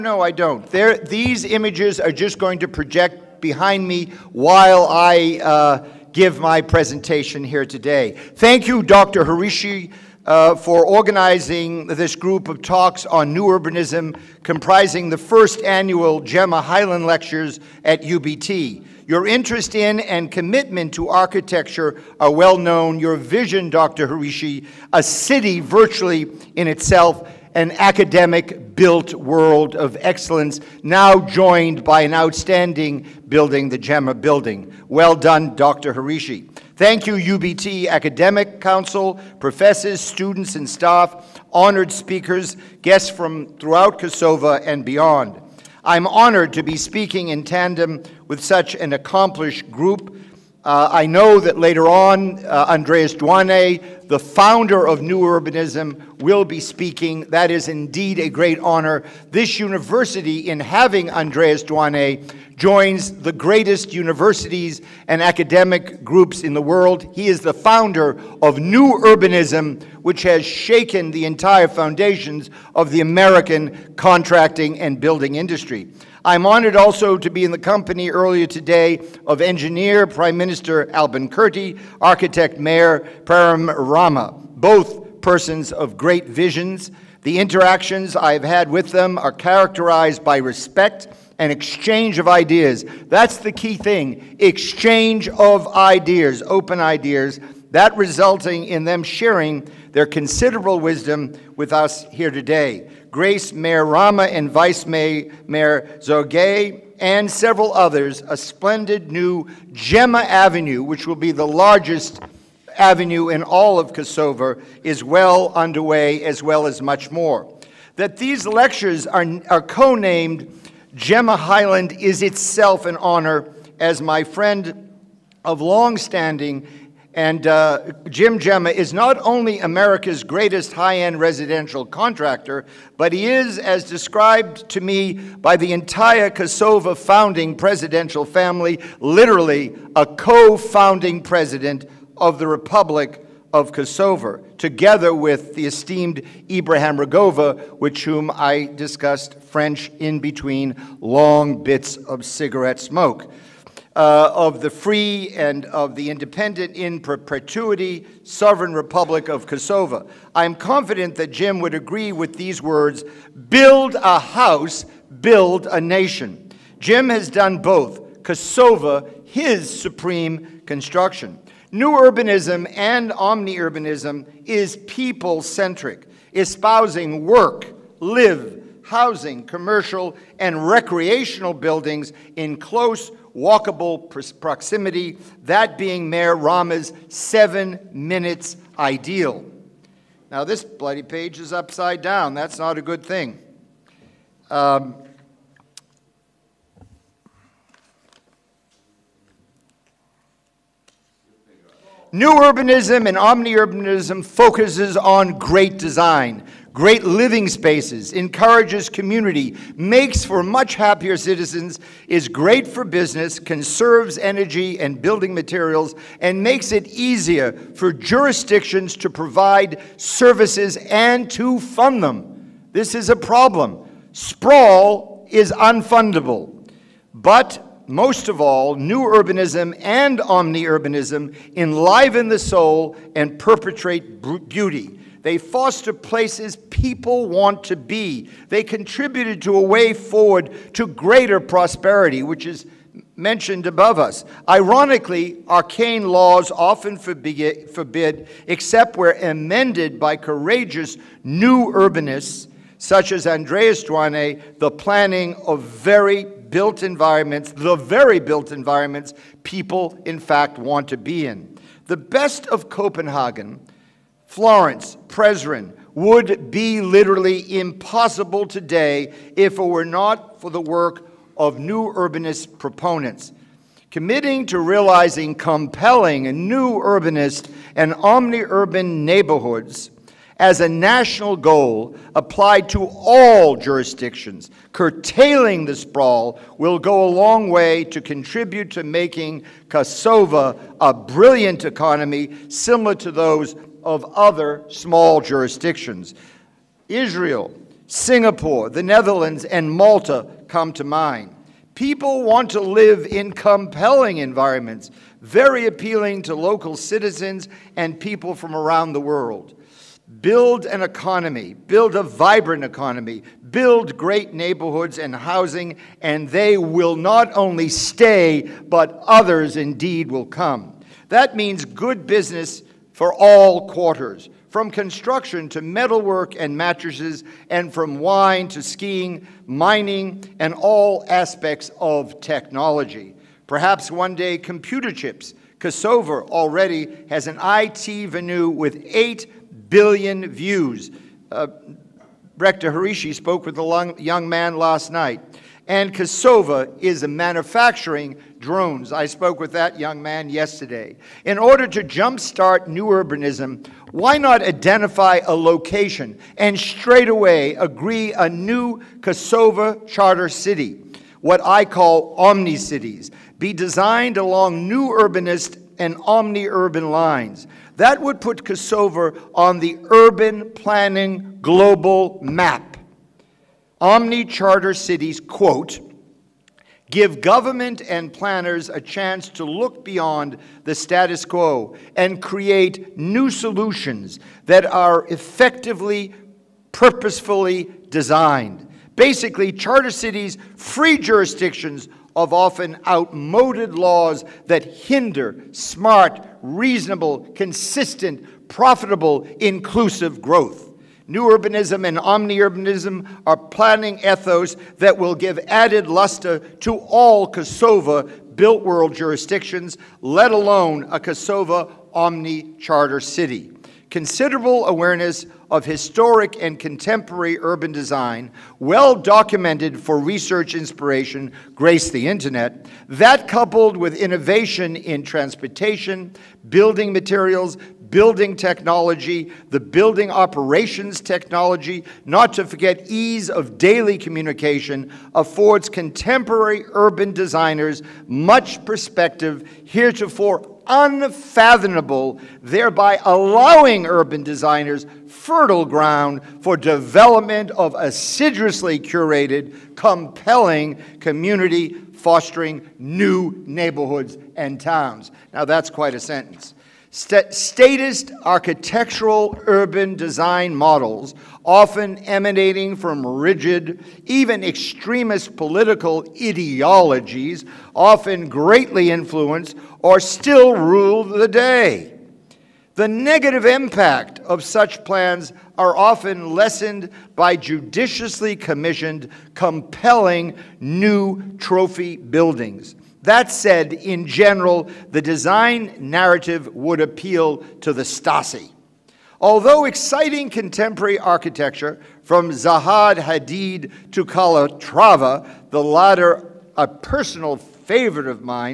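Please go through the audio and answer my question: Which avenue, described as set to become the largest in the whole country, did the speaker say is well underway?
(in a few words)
Gemma Avenue.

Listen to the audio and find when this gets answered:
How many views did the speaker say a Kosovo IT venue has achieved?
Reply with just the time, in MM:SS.
05:38.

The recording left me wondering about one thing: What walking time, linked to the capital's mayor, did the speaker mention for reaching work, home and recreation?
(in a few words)
7 minutes.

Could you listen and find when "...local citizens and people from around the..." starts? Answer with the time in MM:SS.
05:06.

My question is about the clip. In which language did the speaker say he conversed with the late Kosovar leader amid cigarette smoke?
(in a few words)
French.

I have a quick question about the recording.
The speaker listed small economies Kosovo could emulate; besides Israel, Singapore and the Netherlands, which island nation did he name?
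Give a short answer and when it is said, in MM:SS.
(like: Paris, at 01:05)
Malta, at 04:59.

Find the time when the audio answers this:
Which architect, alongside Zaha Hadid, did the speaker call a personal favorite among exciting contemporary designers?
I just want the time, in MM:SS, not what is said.
08:14.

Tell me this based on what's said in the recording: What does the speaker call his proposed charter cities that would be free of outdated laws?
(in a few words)
omni cities.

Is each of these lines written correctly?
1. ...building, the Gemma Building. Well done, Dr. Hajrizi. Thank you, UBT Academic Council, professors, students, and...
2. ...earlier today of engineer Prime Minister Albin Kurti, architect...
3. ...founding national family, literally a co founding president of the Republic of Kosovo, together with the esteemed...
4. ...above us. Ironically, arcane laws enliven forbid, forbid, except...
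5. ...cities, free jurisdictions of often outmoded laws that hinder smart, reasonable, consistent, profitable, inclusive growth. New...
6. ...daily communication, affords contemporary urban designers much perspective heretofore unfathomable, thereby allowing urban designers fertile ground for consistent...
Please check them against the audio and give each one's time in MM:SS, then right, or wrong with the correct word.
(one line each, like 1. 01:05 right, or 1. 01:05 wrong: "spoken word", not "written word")
1. 00:33 right
2. 01:18 right
3. 02:16 wrong: "presidential", not "national"
4. 04:03 wrong: "often", not "enliven"
5. 06:29 right
6. 07:13 wrong: "development", not "consistent".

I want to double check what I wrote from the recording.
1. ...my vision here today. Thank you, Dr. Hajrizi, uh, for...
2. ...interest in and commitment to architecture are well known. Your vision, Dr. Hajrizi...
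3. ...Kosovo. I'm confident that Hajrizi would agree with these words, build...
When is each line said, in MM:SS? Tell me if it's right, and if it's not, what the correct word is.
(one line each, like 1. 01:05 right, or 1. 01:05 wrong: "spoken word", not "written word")
1. 00:06 wrong: "presentation", not "vision"
2. 00:19 right
3. 02:39 wrong: "Jim", not "Hajrizi".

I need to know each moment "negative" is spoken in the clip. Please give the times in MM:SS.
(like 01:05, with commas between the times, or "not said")
07:52.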